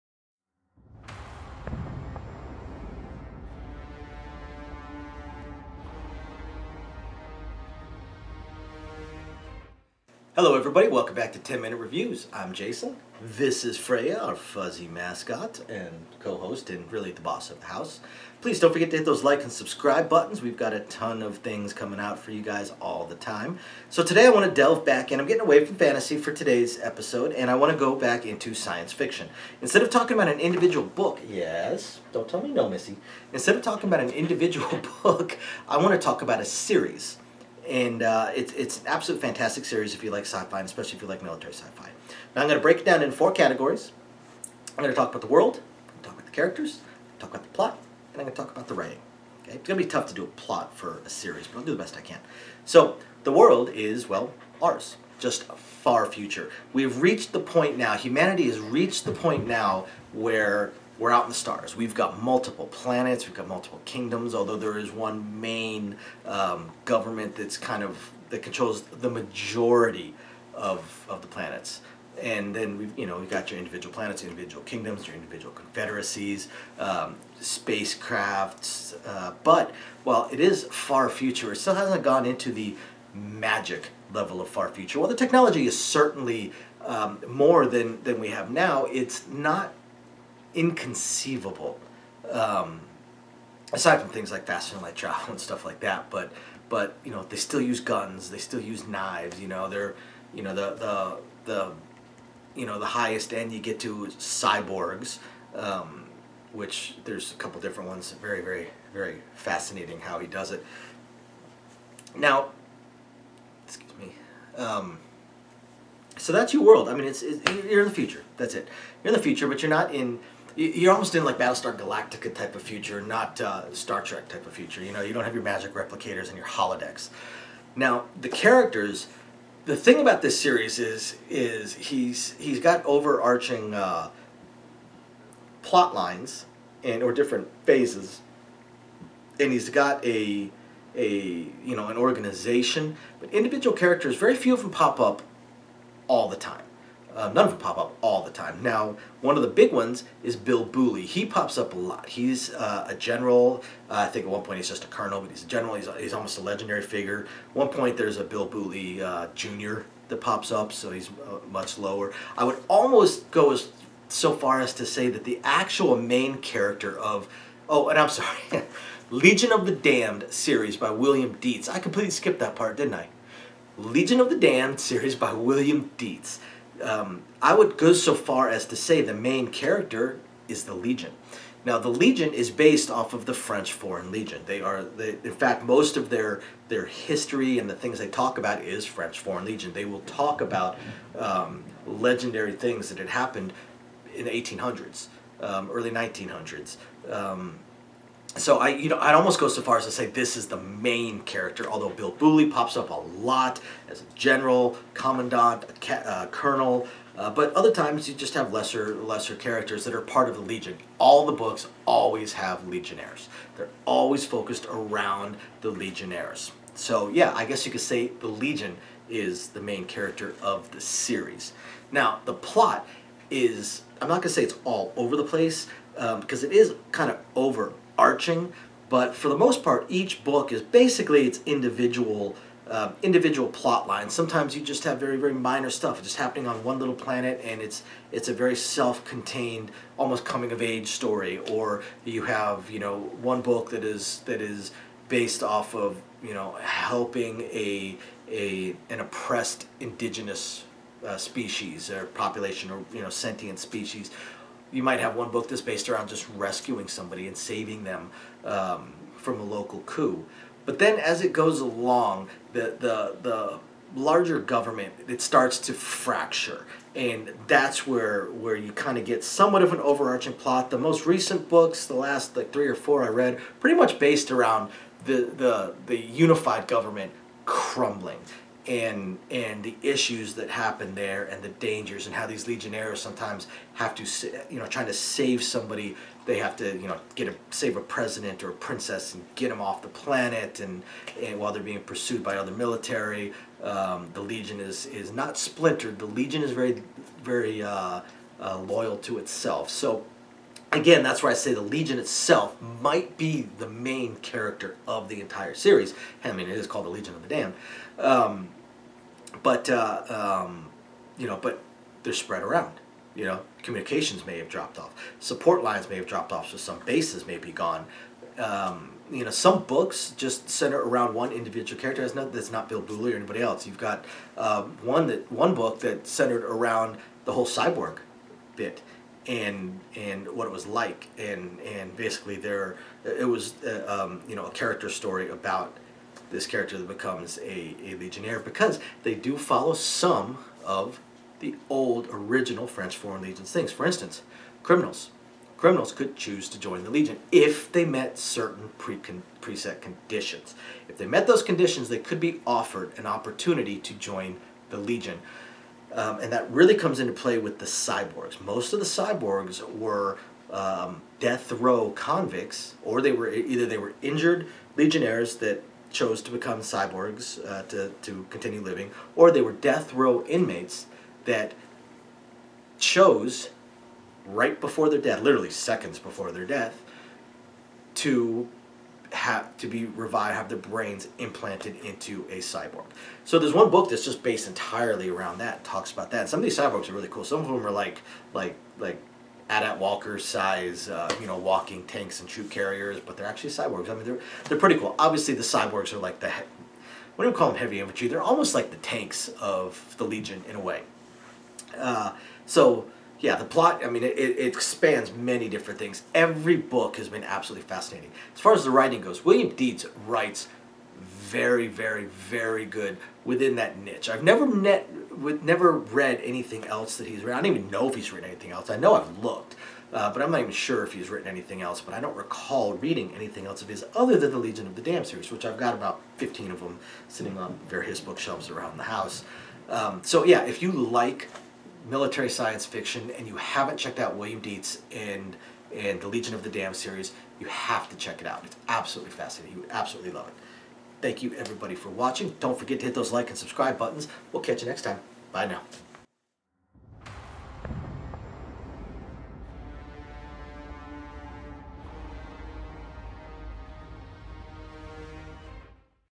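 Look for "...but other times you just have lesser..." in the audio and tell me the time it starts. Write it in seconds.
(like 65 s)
207 s.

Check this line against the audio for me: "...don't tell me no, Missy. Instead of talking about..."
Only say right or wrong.
right.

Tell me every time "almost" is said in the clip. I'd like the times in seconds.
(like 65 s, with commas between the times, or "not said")
120 s, 156 s, 162 s, 199 s, 239 s, 398 s.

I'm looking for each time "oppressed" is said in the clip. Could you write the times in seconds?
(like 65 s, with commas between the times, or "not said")
248 s.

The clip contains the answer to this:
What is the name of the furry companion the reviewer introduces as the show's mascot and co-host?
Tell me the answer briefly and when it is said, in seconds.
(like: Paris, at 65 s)
Freya, at 13 s.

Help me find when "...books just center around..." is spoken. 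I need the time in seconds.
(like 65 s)
319 s.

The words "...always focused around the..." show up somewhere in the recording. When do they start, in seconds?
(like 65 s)
213 s.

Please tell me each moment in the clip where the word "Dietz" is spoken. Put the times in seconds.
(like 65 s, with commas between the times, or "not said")
171 s, 175 s, 409 s, 434 s.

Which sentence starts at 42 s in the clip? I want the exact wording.
Now I'm going to break it down in four categories.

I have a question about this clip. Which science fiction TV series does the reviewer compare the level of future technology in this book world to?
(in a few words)
Battlestar Galactica.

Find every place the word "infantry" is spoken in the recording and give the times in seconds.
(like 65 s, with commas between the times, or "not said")
397 s.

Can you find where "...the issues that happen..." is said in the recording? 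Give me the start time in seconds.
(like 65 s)
279 s.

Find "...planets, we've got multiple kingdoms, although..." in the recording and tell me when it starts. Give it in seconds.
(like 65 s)
62 s.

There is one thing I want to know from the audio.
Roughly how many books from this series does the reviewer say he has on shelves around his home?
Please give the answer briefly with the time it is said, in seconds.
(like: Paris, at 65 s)
15, at 426 s.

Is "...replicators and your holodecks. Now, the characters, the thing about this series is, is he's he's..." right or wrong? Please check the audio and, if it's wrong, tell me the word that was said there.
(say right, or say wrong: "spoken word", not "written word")
right.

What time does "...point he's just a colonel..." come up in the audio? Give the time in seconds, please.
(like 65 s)
154 s.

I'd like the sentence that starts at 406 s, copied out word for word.
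Every book has been absolutely fascinating.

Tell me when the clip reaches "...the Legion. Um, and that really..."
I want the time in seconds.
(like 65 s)
354 s.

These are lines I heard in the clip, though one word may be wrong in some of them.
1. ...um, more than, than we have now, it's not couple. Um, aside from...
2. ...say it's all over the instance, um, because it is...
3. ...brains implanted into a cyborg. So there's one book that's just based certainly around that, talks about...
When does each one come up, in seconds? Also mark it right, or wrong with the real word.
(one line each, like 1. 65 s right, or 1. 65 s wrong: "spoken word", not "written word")
1. 86 s wrong: "inconceivable", not "couple"
2. 224 s wrong: "place", not "instance"
3. 380 s wrong: "entirely", not "certainly".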